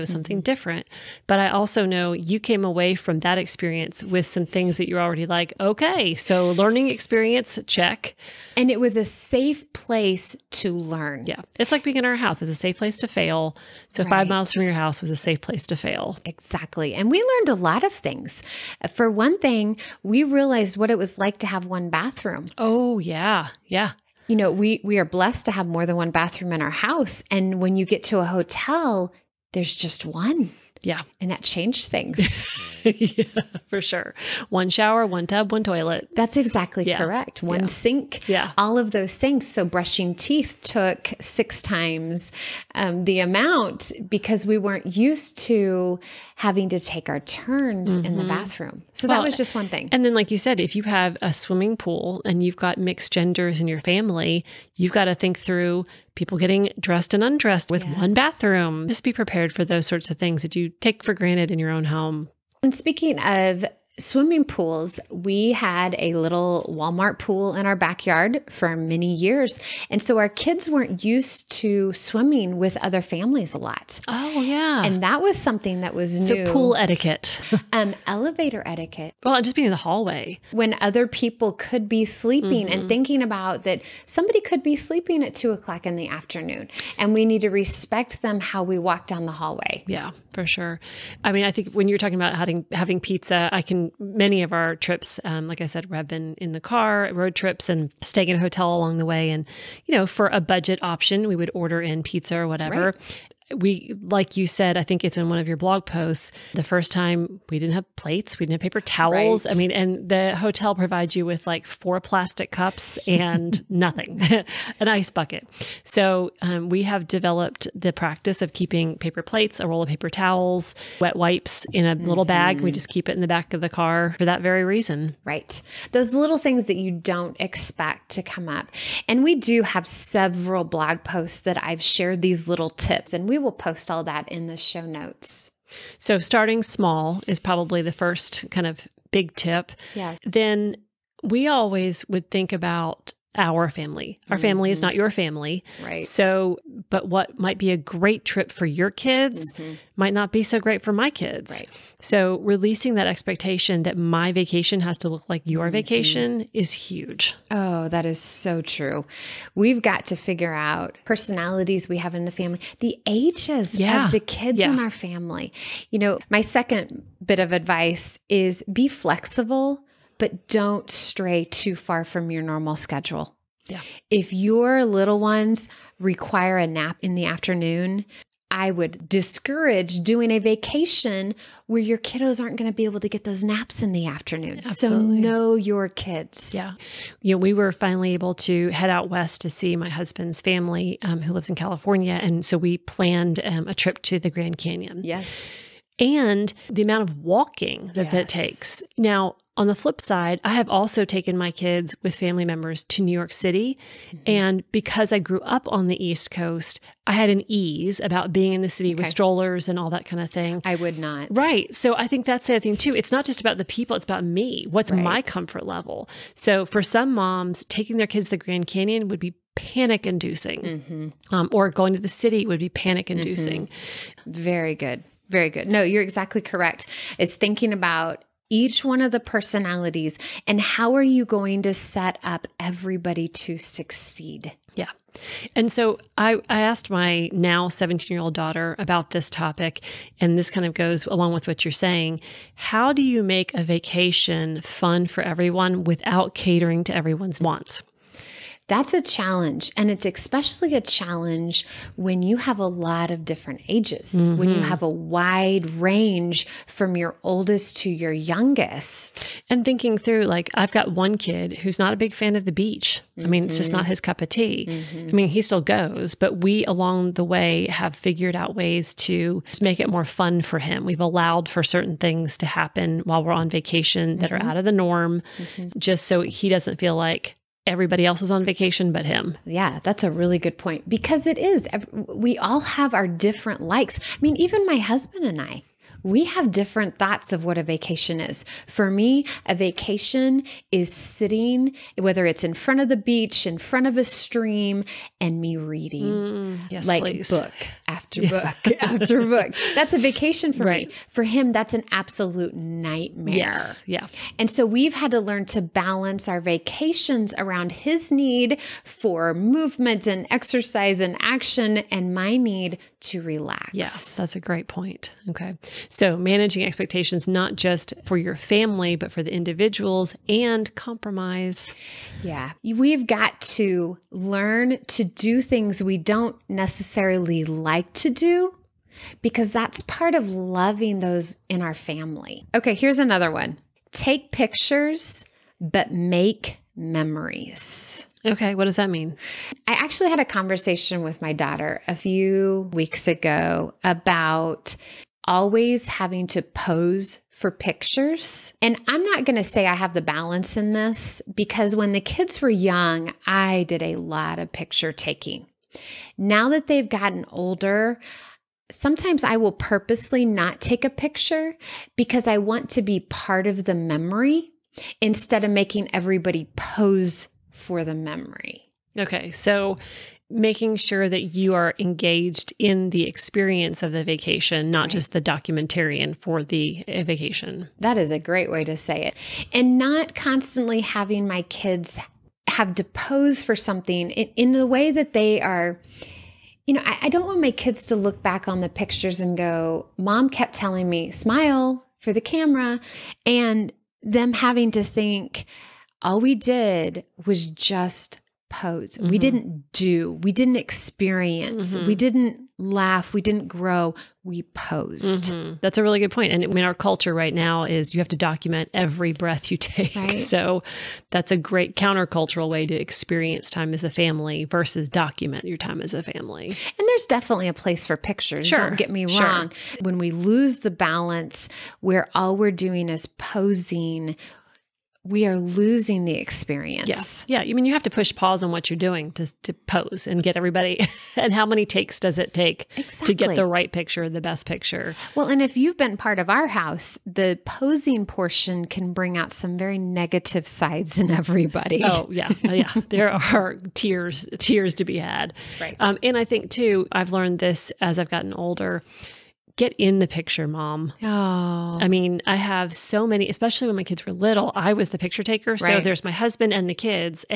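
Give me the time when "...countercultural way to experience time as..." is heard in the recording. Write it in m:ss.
6:51.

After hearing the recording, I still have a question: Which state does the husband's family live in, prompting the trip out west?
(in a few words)
California.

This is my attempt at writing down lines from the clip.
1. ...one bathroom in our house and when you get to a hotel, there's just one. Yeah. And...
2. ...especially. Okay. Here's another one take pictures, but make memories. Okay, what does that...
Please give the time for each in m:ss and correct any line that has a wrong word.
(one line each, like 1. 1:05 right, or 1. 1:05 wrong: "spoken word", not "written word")
1. 0:25 right
2. 5:31 wrong: "family", not "especially".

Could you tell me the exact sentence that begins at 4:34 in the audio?
out of the norm, just so he doesn't feel like everybody else is on vacation but him.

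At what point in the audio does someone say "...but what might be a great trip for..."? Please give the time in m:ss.
2:26.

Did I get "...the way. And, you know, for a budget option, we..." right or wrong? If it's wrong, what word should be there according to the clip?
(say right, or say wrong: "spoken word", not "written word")
right.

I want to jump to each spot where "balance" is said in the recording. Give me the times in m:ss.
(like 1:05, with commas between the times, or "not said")
5:05, 5:50, 7:00.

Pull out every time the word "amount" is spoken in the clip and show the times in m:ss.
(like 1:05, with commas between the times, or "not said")
0:43, 3:16.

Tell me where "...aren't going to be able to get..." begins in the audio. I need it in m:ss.
3:02.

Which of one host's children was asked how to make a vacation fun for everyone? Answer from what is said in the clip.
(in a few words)
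17 year old daughter.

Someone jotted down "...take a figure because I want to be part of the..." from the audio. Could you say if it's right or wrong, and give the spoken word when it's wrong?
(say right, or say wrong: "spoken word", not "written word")
wrong: "picture", not "figure".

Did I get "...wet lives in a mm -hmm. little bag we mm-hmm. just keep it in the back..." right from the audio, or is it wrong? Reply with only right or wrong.
wrong.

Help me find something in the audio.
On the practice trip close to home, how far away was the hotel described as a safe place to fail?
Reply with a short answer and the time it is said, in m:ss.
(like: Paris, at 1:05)
5 miles, at 0:14.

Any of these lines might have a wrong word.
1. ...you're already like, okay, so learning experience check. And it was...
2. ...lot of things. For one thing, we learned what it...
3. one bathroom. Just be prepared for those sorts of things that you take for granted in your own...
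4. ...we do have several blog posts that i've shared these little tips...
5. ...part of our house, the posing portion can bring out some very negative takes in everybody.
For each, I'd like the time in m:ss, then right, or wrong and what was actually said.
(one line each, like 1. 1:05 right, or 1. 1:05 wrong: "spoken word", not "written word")
1. 0:04 right
2. 0:17 wrong: "realized", not "learned"
3. 0:58 right
4. 2:09 right
5. 7:15 wrong: "sides", not "takes".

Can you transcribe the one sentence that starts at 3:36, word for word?
So for some moms, taking their kids to the Grand Canyon would be panic inducing, mm -hmm.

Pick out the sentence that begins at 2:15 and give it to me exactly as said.
So, starting small is probably the first kind of big tip.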